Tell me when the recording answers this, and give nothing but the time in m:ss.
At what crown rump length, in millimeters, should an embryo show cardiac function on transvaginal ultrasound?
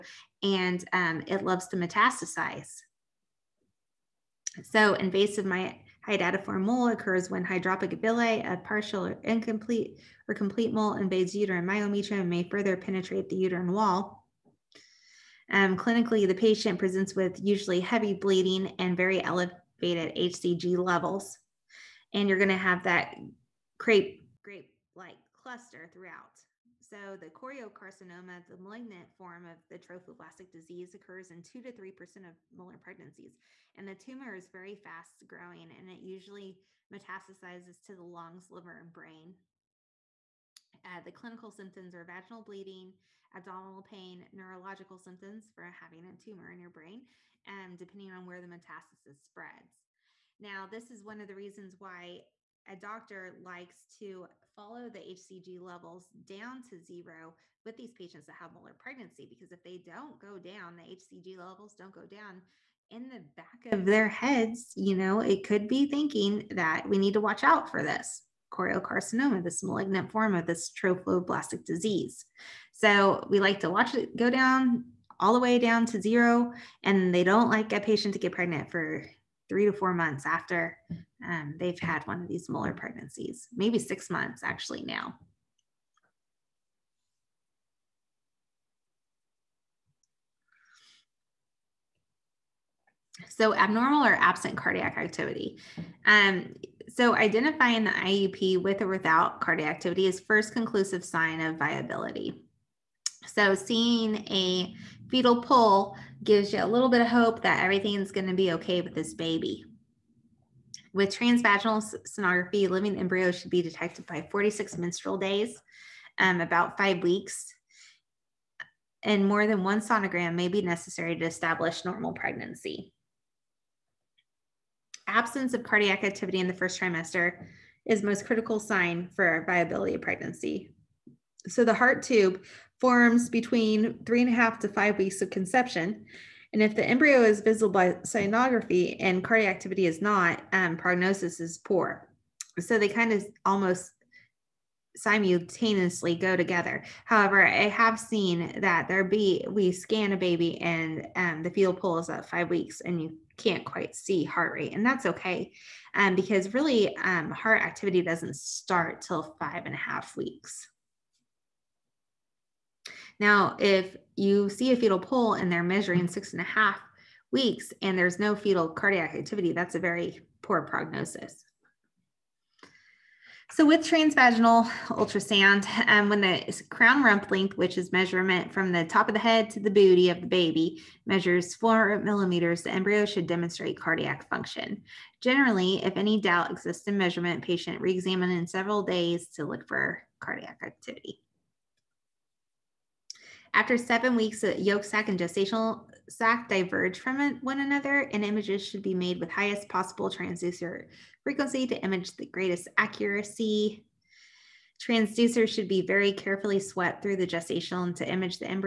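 3:01.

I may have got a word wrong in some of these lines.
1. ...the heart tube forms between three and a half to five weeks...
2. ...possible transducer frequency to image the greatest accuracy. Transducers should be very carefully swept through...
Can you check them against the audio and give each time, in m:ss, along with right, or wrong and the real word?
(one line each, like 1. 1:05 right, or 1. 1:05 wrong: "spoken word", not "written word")
1. 2:11 right
2. 3:19 right.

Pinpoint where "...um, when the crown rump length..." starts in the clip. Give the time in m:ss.
2:55.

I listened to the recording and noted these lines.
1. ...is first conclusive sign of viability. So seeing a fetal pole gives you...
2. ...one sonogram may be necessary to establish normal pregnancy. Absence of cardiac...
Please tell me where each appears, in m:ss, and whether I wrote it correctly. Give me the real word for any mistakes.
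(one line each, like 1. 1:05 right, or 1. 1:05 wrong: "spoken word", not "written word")
1. 1:40 right
2. 1:59 right.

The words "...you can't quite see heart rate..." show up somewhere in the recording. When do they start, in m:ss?
2:33.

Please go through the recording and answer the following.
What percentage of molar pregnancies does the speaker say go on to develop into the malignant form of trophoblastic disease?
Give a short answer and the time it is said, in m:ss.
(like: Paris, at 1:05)
2 to 3 percent, at 0:31.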